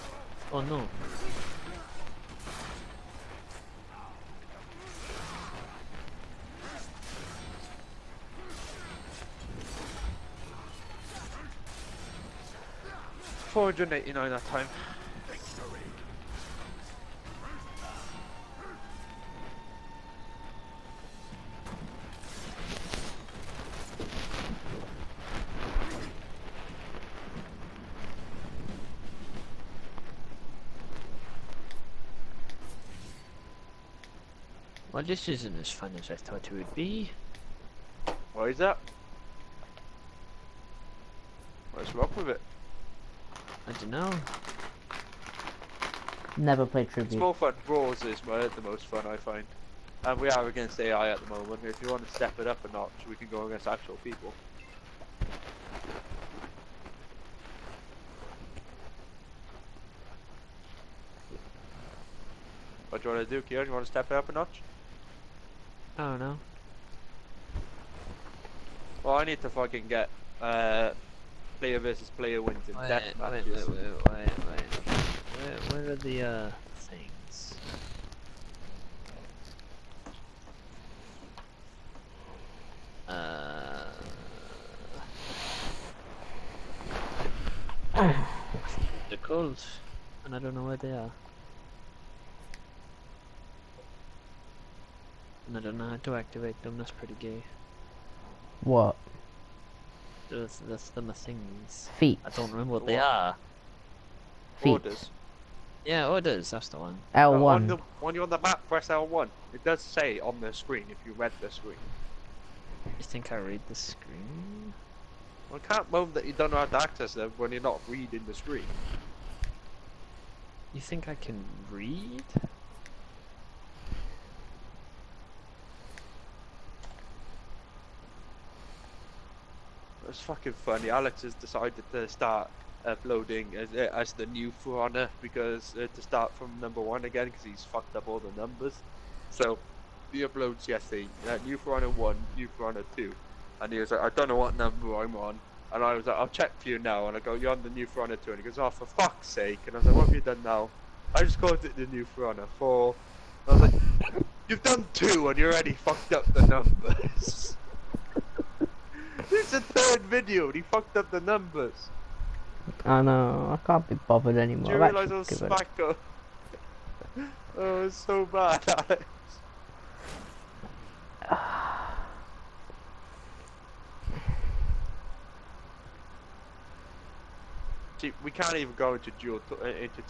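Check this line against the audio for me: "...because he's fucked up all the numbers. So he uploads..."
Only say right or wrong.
right.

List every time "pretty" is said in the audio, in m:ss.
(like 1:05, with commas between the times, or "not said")
1:36.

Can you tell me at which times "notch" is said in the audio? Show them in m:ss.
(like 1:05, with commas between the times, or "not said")
0:52, 1:04.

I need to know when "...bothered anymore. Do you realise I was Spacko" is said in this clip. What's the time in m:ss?
2:44.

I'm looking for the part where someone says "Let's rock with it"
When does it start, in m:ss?
0:41.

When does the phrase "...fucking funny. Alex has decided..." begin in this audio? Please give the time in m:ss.
2:10.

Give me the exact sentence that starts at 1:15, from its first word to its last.
Where, where are the uh, things?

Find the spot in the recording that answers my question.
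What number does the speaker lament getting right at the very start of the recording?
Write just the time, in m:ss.
0:13.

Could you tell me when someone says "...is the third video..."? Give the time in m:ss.
2:39.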